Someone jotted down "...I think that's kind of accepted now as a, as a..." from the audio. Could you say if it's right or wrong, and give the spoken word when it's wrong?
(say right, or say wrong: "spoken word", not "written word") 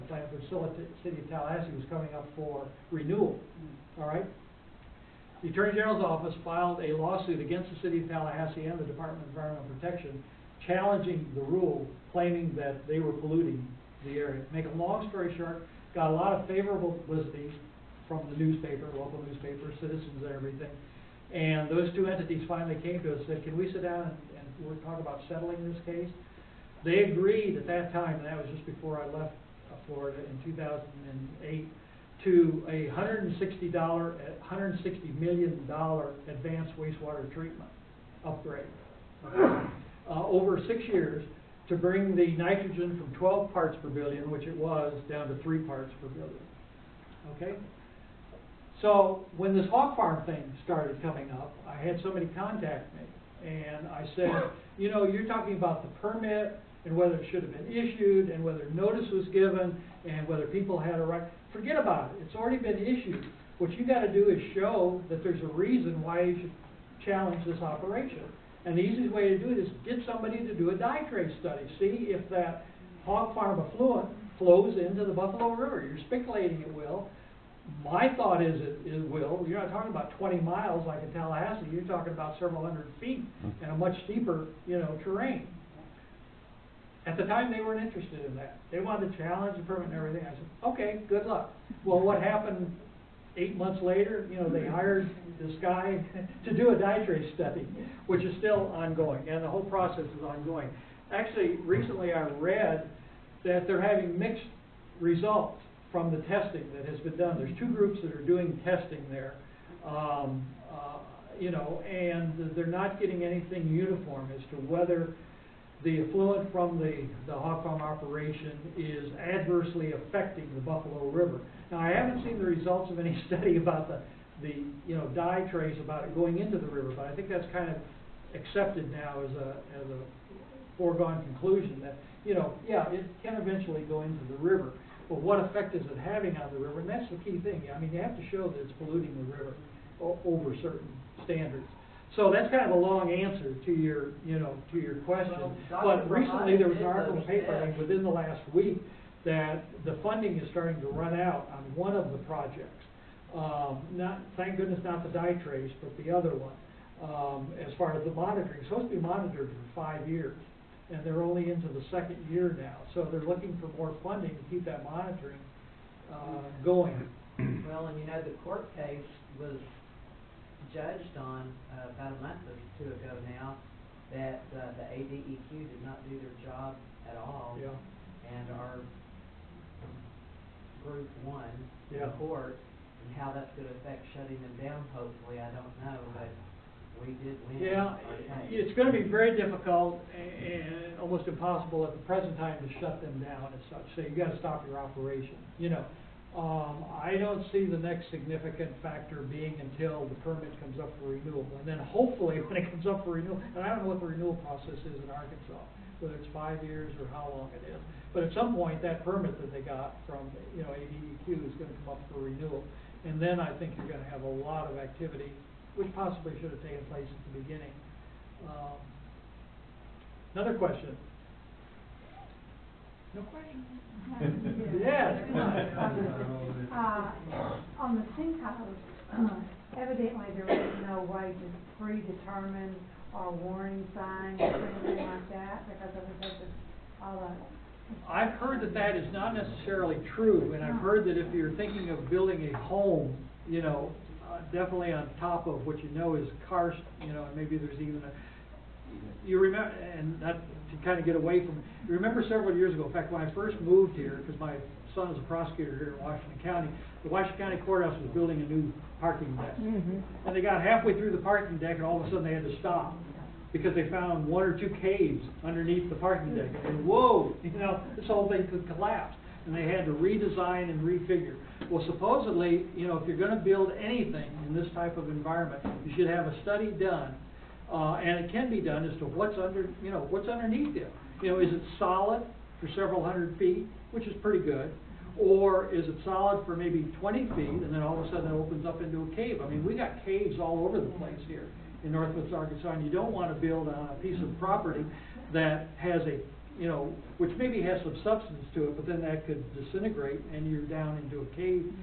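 right.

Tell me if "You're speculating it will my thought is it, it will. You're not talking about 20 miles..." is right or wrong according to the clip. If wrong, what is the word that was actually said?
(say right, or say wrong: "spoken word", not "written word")
right.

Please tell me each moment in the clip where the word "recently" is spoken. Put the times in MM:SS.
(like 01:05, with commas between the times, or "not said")
01:41, 02:26.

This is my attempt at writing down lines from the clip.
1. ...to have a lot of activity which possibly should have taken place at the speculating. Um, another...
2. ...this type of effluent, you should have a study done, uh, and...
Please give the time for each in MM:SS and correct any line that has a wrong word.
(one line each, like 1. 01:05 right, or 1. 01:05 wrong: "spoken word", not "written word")
1. 03:34 wrong: "beginning", not "speculating"
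2. 04:34 wrong: "environment", not "effluent".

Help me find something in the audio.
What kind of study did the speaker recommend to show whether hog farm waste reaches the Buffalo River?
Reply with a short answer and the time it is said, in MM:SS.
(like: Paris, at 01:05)
dye trace study, at 01:10.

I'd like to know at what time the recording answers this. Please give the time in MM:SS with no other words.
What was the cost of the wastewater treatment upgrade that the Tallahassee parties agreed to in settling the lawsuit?
00:33.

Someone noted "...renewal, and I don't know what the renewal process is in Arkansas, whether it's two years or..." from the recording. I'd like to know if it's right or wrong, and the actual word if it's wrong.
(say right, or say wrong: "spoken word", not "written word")
wrong: "five", not "two".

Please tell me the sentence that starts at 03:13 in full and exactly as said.
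So you've got to stop your operation.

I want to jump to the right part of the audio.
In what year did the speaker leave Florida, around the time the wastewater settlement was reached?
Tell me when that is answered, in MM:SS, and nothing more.
00:30.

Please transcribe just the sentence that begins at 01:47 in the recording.
There's two groups that are doing testing there.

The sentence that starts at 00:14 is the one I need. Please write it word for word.
make a long story short, got a lot of favorable publicity from the newspaper, local newspaper, citizens and everything.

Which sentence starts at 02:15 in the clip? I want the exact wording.
Well, what effect is it having on the river?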